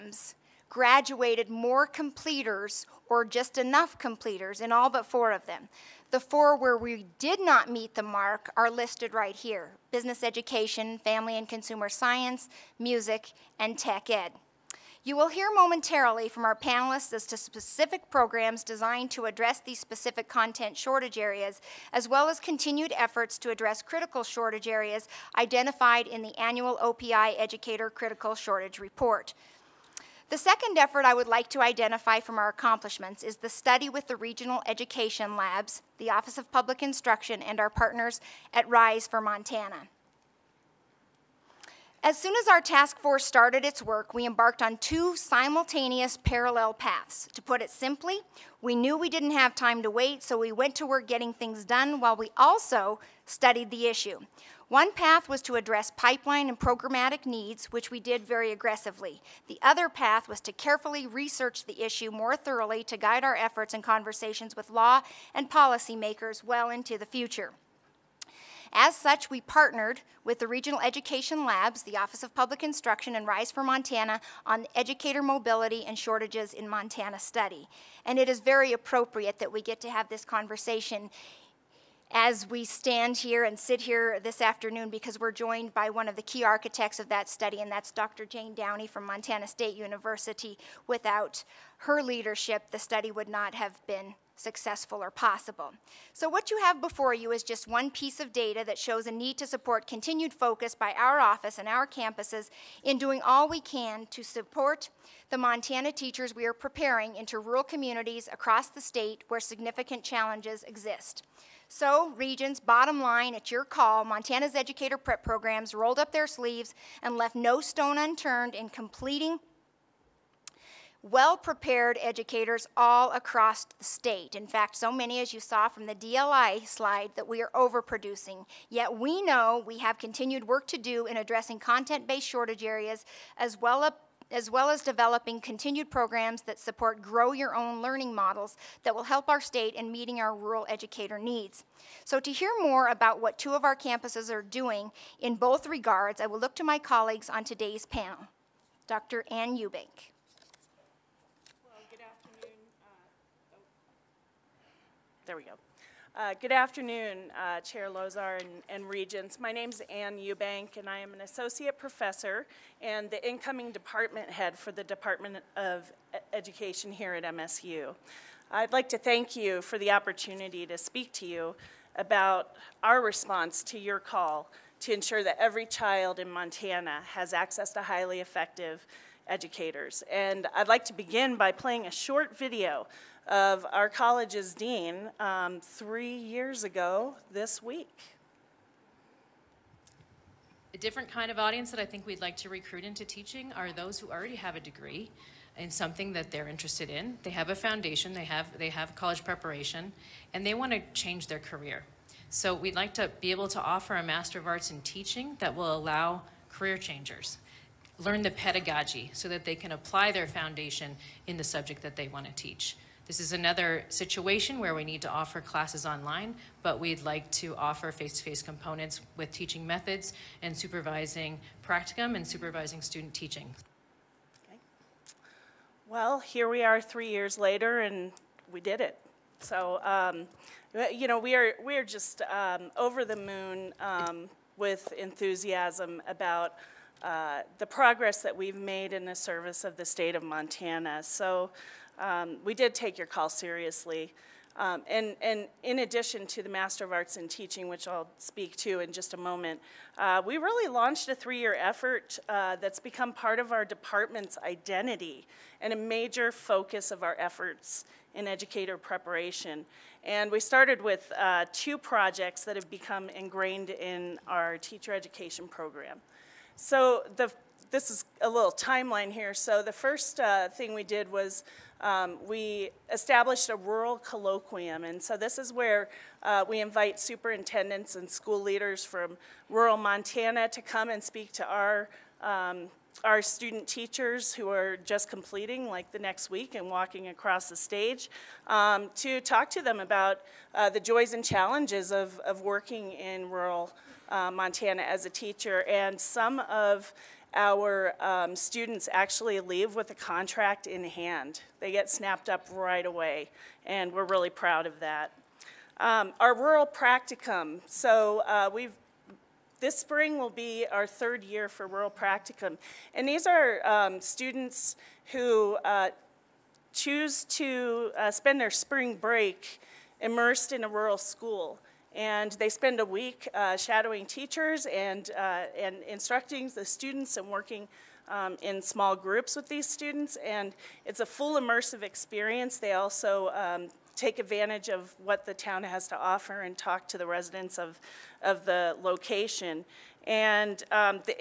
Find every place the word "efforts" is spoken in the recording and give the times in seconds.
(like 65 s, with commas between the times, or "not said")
22 s, 30 s, 63 s, 251 s, 257 s.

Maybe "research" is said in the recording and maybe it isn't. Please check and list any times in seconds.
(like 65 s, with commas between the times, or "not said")
61 s.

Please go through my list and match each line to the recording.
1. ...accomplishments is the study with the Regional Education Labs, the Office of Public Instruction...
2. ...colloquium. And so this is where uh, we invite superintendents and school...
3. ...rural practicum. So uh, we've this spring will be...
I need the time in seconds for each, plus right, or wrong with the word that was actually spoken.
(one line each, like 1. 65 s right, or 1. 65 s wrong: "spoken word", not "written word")
1. 32 s right
2. 273 s right
3. 306 s right.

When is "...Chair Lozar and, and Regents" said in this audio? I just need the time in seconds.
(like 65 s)
157 s.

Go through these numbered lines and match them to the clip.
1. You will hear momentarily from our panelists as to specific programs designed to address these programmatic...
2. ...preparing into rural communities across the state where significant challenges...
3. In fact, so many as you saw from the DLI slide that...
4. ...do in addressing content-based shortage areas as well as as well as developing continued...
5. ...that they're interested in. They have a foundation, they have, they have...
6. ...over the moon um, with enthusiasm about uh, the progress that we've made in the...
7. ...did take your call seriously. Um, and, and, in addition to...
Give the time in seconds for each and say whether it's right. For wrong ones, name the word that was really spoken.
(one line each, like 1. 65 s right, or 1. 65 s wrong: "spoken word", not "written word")
1. 15 s wrong: "specific", not "programmatic"
2. 106 s right
3. 124 s right
4. 130 s right
5. 196 s right
6. 232 s right
7. 242 s right.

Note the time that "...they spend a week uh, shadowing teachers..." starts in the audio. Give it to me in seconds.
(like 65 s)
322 s.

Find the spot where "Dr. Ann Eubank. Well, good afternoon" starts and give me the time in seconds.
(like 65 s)
148 s.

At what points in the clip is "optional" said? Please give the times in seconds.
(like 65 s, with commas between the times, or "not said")
not said.